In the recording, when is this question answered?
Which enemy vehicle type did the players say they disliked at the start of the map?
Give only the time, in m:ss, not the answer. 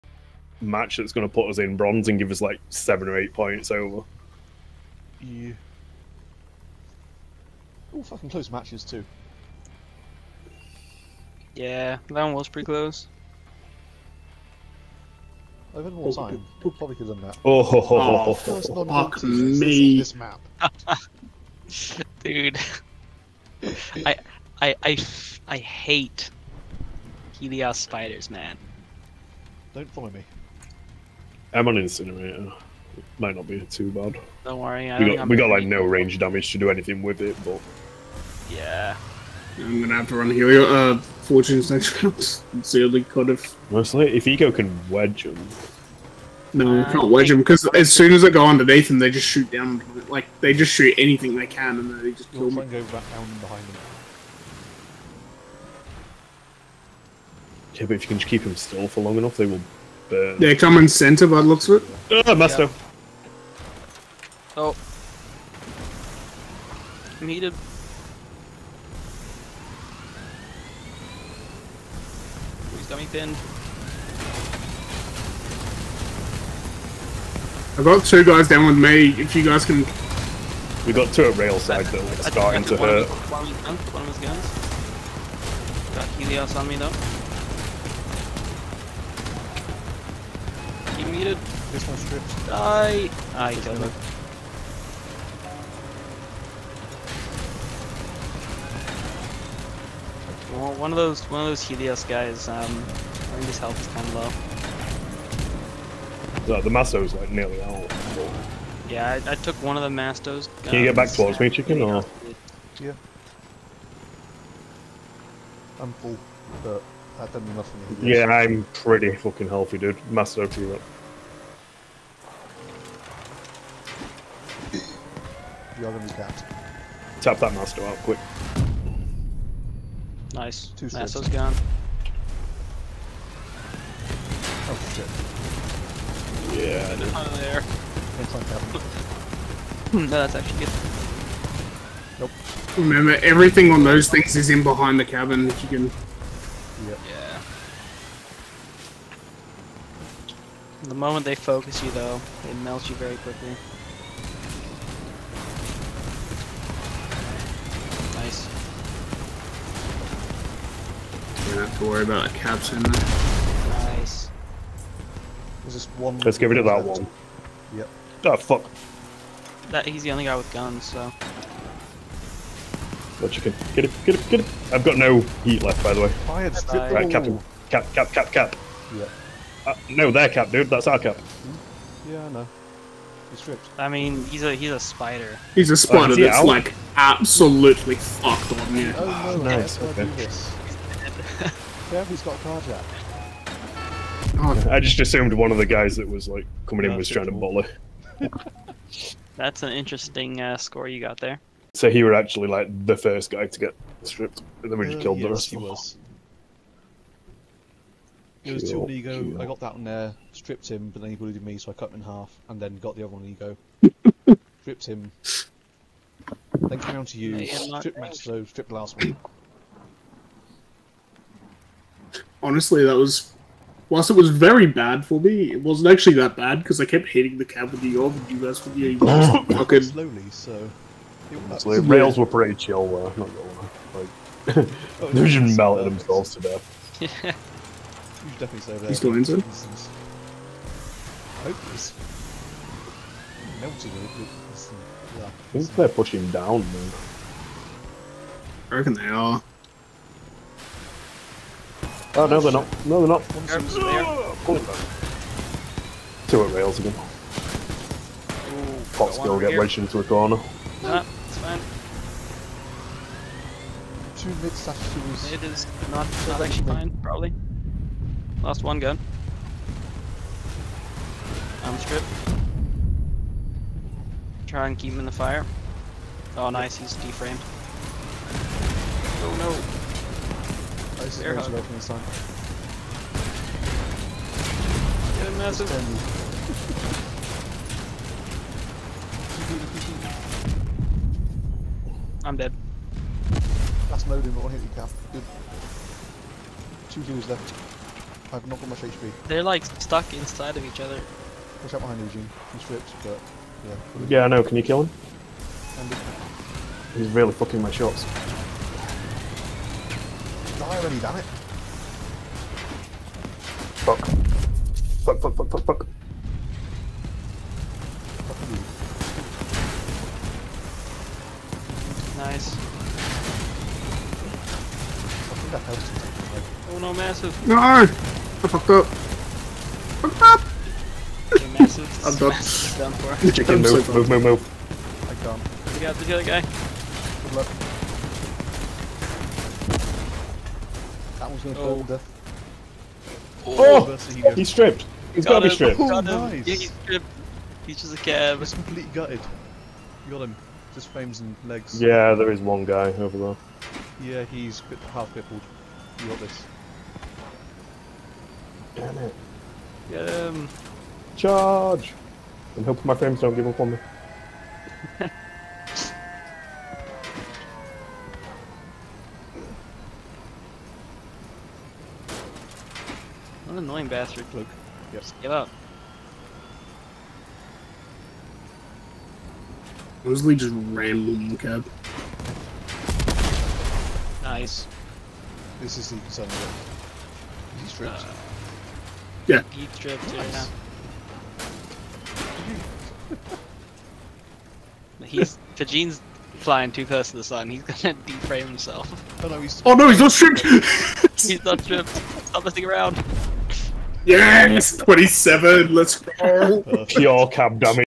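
0:27.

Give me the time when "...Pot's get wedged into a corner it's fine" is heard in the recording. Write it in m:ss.
4:18.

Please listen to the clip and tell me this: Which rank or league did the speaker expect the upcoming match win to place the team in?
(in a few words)
Bronze.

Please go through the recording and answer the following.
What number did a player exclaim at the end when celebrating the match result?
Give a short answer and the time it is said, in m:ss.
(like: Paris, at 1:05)
27, at 6:44.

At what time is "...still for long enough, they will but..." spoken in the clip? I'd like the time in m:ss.
0:58.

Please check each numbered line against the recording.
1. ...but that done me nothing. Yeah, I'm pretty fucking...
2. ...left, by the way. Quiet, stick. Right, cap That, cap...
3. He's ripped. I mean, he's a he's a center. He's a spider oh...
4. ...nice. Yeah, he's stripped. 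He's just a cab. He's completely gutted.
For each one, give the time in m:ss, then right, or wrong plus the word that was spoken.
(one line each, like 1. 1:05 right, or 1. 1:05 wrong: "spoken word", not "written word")
1. 1:56 right
2. 2:55 wrong: "Cap", not "That"
3. 3:03 wrong: "spider", not "center"
4. 5:46 right.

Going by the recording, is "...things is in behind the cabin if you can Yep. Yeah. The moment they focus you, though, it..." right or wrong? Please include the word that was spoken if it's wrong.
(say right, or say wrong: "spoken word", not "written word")
right.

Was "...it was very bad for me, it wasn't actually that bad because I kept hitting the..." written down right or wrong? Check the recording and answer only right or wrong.
right.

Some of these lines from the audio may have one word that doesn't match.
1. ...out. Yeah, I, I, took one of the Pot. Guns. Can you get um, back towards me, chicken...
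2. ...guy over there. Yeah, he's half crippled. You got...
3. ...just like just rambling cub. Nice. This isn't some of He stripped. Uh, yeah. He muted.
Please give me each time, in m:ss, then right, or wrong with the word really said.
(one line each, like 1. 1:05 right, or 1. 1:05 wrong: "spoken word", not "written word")
1. 1:47 wrong: "Mastos", not "Pot"
2. 5:52 right
3. 6:20 wrong: "stripped", not "muted".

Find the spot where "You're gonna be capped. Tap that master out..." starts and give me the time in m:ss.
2:05.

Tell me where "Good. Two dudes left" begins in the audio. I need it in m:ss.
4:55.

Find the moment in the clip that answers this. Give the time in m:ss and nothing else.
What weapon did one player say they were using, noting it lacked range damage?
0:31.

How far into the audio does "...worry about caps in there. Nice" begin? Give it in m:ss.
2:41.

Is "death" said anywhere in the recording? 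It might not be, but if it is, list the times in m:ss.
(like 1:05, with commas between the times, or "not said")
3:56, 5:41.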